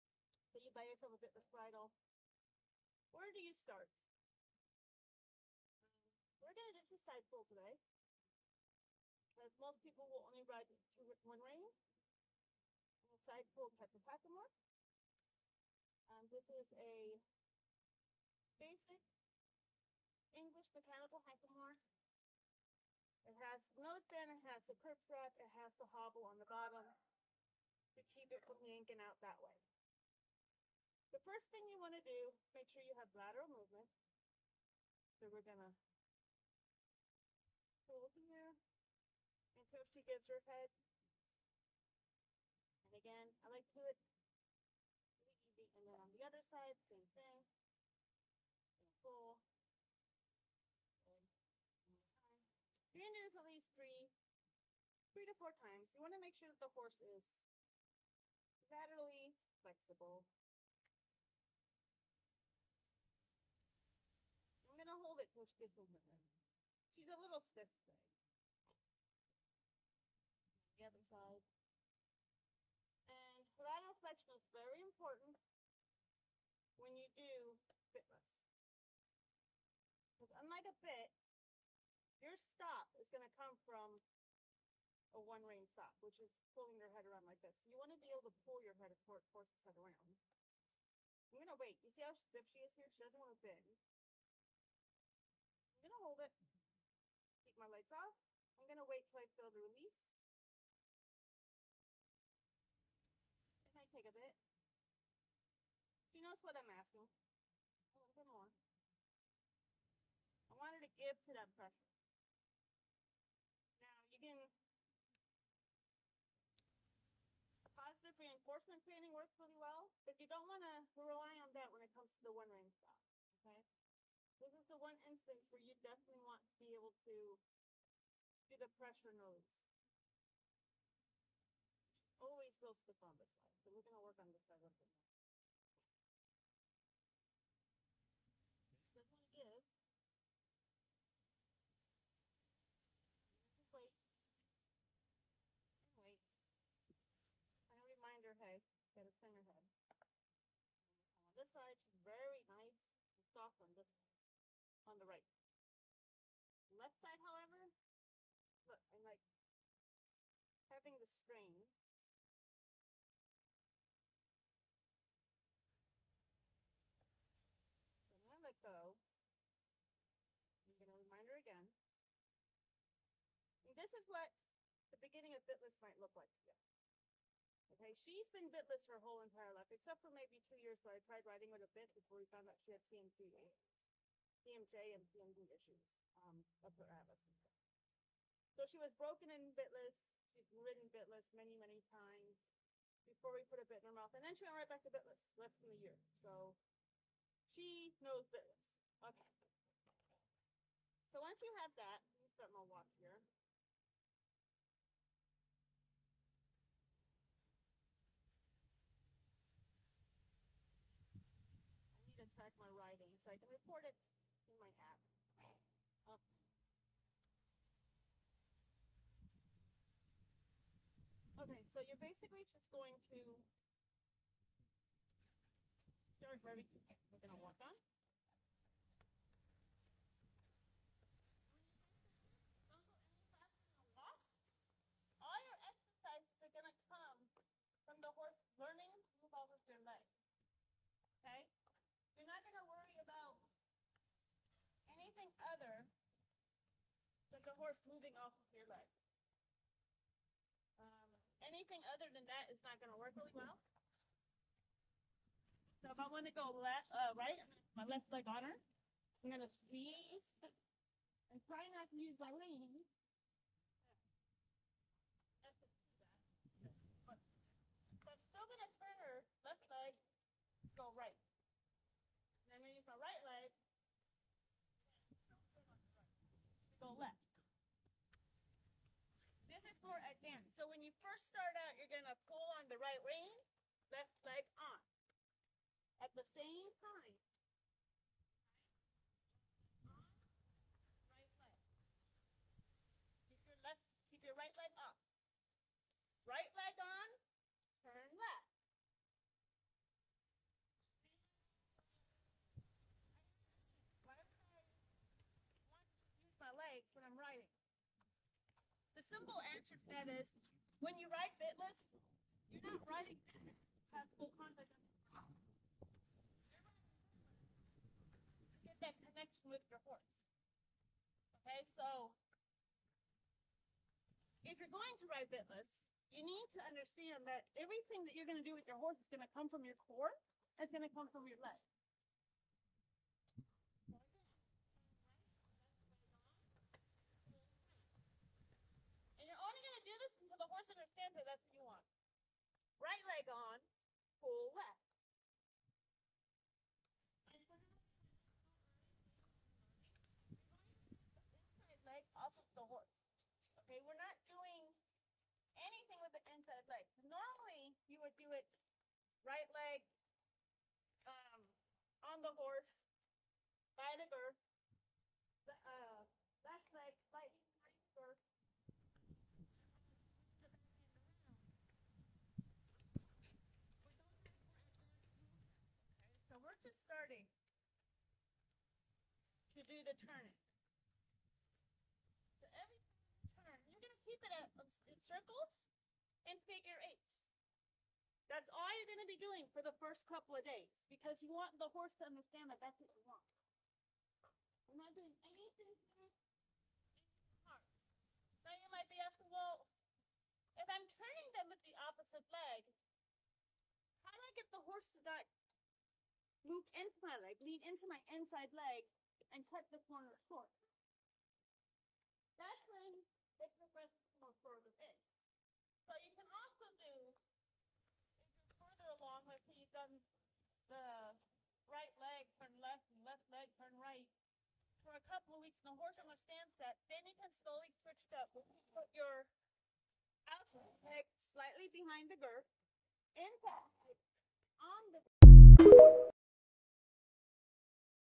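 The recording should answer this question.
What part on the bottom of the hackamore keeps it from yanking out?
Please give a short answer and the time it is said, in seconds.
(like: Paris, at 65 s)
hobble, at 25 s.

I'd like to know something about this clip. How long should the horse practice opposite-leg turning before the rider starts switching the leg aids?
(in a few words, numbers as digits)
a couple of weeks.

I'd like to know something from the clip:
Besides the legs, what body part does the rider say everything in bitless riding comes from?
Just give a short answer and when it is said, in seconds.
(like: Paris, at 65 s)
core, at 329 s.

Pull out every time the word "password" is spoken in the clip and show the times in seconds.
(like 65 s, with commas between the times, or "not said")
not said.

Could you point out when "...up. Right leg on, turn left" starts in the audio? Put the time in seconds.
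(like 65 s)
294 s.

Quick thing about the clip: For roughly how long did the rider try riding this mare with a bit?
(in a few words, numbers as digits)
2 years.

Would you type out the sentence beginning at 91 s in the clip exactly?
You see how stiff she is here?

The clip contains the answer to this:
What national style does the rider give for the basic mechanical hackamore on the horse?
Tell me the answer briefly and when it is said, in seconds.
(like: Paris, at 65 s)
English, at 20 s.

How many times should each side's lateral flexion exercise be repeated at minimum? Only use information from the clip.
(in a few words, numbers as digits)
3 to 4 times.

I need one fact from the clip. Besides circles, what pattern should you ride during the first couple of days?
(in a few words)
figure eights.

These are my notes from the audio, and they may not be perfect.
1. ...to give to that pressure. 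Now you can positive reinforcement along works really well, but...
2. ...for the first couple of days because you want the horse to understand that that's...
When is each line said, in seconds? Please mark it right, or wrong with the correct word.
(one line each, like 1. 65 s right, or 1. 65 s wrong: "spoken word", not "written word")
1. 110 s wrong: "training", not "along"
2. 389 s right.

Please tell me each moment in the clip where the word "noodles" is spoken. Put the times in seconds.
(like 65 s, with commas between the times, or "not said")
not said.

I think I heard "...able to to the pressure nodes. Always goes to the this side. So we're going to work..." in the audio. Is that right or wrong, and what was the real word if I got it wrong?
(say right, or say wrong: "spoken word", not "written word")
right.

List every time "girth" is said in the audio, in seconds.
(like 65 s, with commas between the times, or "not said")
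364 s, 432 s.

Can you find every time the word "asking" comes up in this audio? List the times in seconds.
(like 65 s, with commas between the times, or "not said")
106 s, 399 s.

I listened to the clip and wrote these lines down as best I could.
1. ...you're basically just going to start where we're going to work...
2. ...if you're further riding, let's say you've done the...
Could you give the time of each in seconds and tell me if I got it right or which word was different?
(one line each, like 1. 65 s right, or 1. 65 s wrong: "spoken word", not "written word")
1. 221 s right
2. 417 s wrong: "along", not "riding".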